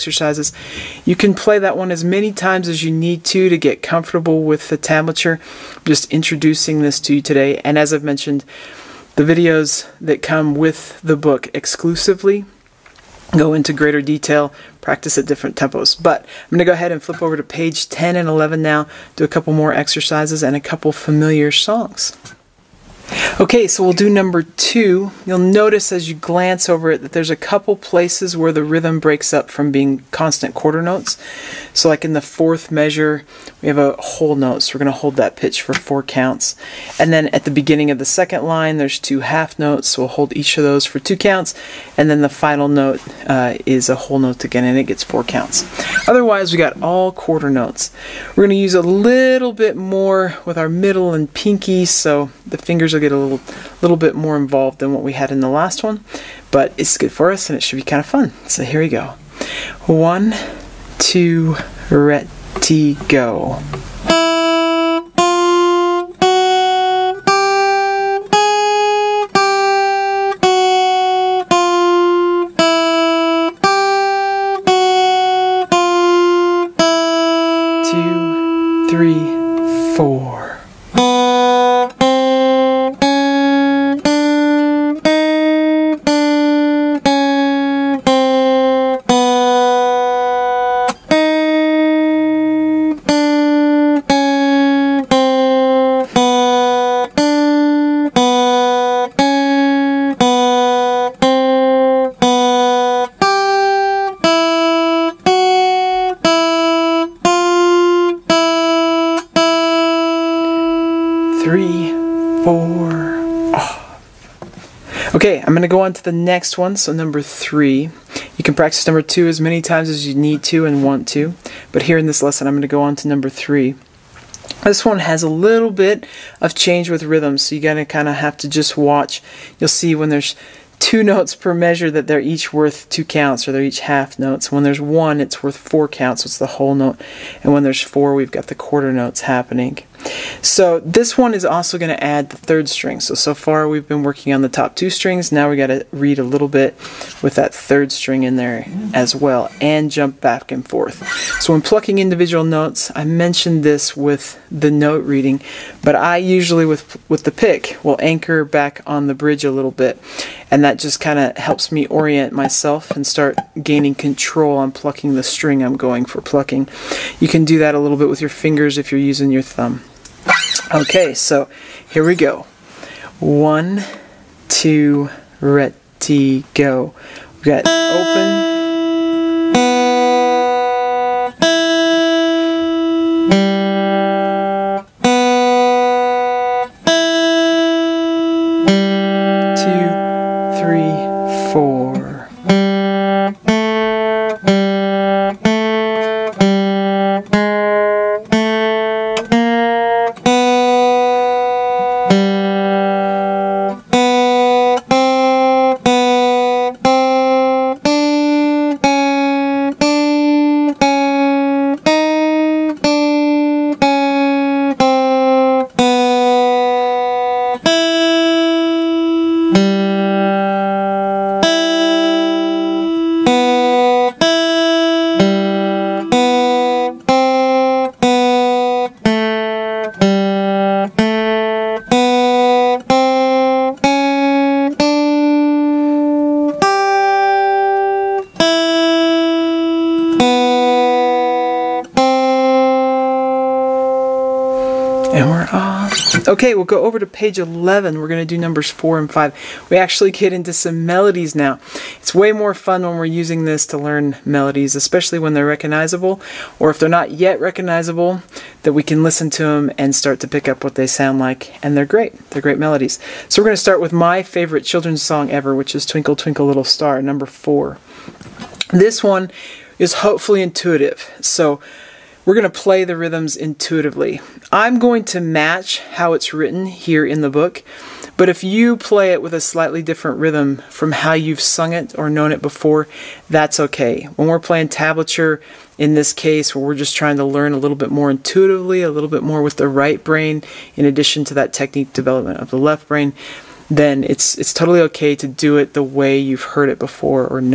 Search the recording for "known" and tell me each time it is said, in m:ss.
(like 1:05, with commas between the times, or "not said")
4:42.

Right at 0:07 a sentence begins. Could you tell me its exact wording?
And as I've mentioned, the videos that come with the book exclusively go into greater detail, practice at different tempos.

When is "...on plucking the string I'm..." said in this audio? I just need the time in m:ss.
2:44.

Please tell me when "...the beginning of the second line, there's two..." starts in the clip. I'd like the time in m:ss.
0:37.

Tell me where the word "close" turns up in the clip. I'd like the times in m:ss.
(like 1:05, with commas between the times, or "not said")
not said.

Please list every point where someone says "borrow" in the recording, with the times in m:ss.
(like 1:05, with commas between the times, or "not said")
not said.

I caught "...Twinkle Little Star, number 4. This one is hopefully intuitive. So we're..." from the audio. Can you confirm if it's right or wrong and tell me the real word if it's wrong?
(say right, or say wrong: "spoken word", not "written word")
right.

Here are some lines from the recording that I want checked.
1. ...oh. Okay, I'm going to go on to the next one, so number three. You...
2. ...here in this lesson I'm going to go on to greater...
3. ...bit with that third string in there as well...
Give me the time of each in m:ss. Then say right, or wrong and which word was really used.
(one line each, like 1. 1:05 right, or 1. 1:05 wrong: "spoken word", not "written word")
1. 1:53 right
2. 2:01 wrong: "number", not "greater"
3. 2:26 right.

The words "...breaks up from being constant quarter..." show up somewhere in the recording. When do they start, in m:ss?
0:28.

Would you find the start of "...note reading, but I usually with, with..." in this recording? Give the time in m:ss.
2:34.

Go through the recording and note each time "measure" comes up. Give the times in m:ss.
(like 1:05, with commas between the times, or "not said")
0:32, 2:11.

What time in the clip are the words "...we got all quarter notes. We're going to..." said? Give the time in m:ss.
0:46.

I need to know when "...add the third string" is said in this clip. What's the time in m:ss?
2:22.